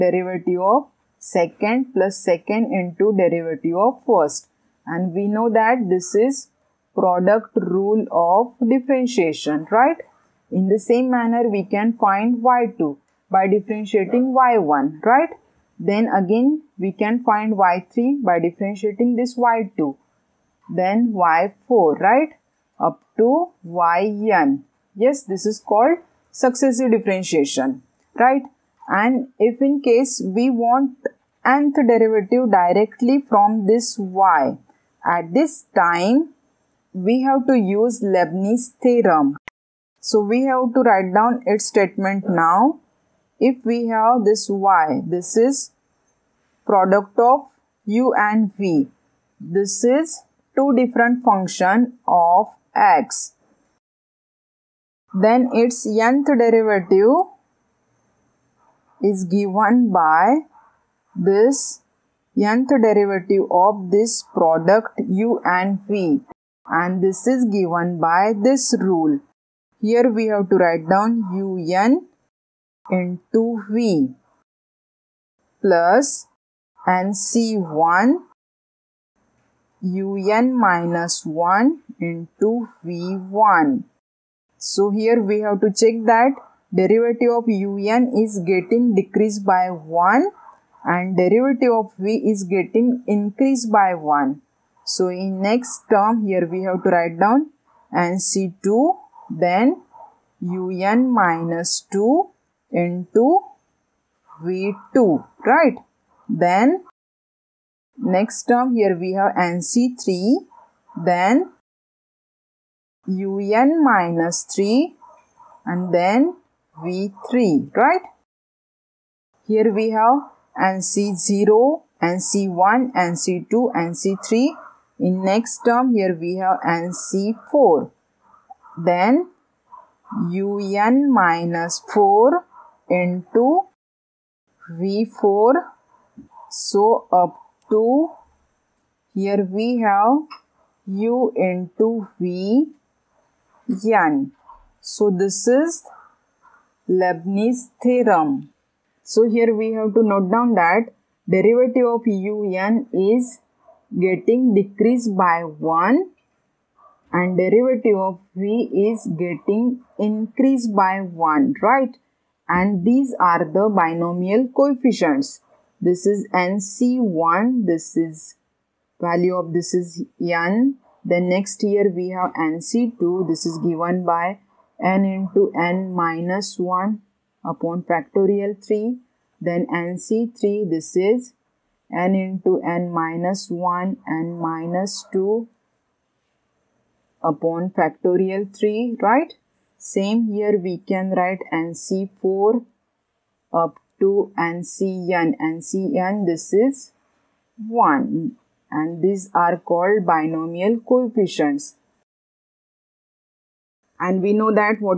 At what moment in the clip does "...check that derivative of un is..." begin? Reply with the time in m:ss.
1:25.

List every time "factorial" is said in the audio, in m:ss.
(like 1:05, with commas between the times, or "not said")
2:57, 3:07.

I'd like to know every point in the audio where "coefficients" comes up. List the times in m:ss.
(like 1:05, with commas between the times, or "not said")
2:44, 3:20.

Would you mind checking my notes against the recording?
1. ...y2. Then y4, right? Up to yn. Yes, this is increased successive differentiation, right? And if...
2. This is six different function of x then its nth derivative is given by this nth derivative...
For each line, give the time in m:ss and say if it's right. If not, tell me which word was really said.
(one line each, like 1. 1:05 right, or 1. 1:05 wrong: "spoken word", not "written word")
1. 0:19 wrong: "called", not "increased"
2. 0:49 wrong: "two", not "six".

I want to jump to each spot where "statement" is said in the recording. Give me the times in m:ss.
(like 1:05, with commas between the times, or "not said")
0:41.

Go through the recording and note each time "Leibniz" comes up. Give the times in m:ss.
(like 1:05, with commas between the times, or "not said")
0:38, 2:26.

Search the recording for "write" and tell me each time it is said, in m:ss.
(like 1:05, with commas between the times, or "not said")
0:40, 1:10, 1:36, 3:11.